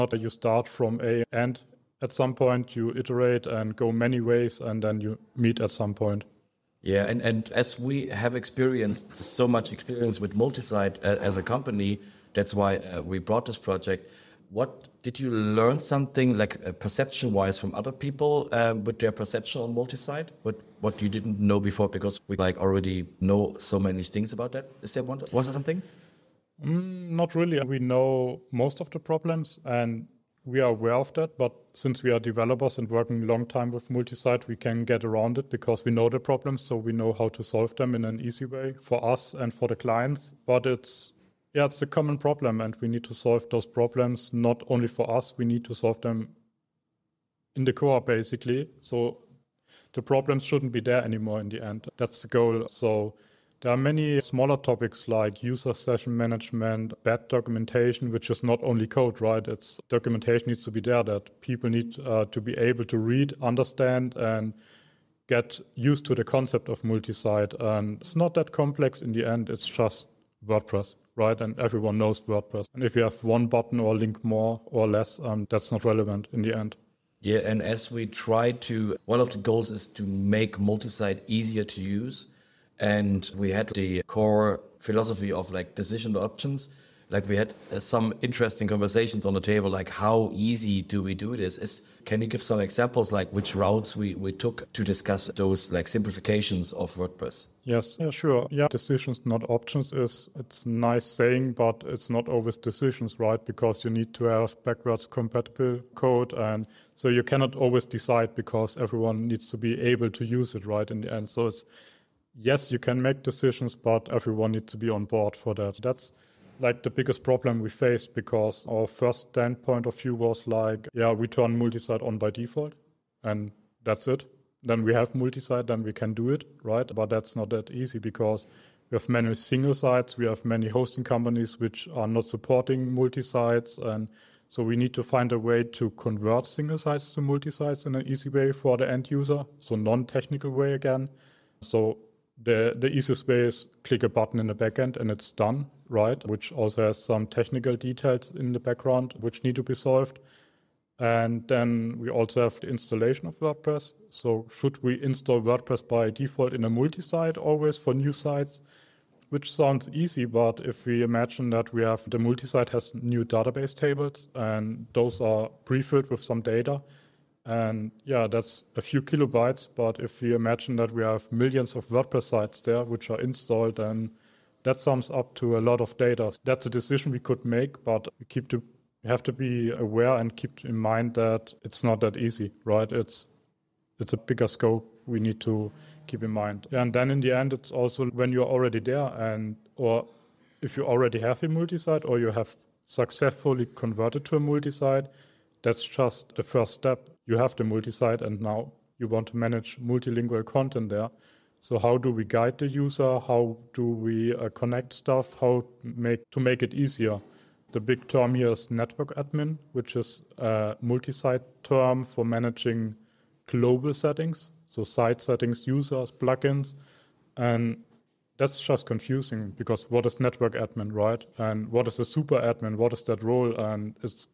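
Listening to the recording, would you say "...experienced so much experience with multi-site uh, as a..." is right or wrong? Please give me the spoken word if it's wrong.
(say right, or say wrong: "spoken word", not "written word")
right.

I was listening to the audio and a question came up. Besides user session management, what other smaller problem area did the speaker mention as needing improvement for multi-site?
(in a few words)
bad documentation.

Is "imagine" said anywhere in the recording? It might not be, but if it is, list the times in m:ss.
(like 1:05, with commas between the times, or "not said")
2:41, 2:50.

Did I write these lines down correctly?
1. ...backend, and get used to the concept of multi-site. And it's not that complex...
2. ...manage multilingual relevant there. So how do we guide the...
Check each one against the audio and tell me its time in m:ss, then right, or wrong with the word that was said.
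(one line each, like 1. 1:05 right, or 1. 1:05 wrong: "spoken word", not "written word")
1. 1:03 wrong: "understand", not "backend"
2. 3:19 wrong: "content", not "relevant".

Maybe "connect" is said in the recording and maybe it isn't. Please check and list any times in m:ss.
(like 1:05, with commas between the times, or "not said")
3:24.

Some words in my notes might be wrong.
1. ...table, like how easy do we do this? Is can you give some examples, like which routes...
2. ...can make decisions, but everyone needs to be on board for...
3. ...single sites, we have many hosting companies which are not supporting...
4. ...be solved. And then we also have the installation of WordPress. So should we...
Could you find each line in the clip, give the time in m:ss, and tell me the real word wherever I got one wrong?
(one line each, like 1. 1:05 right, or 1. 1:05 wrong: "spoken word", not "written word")
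1. 1:29 right
2. 1:52 right
3. 2:09 right
4. 2:29 right.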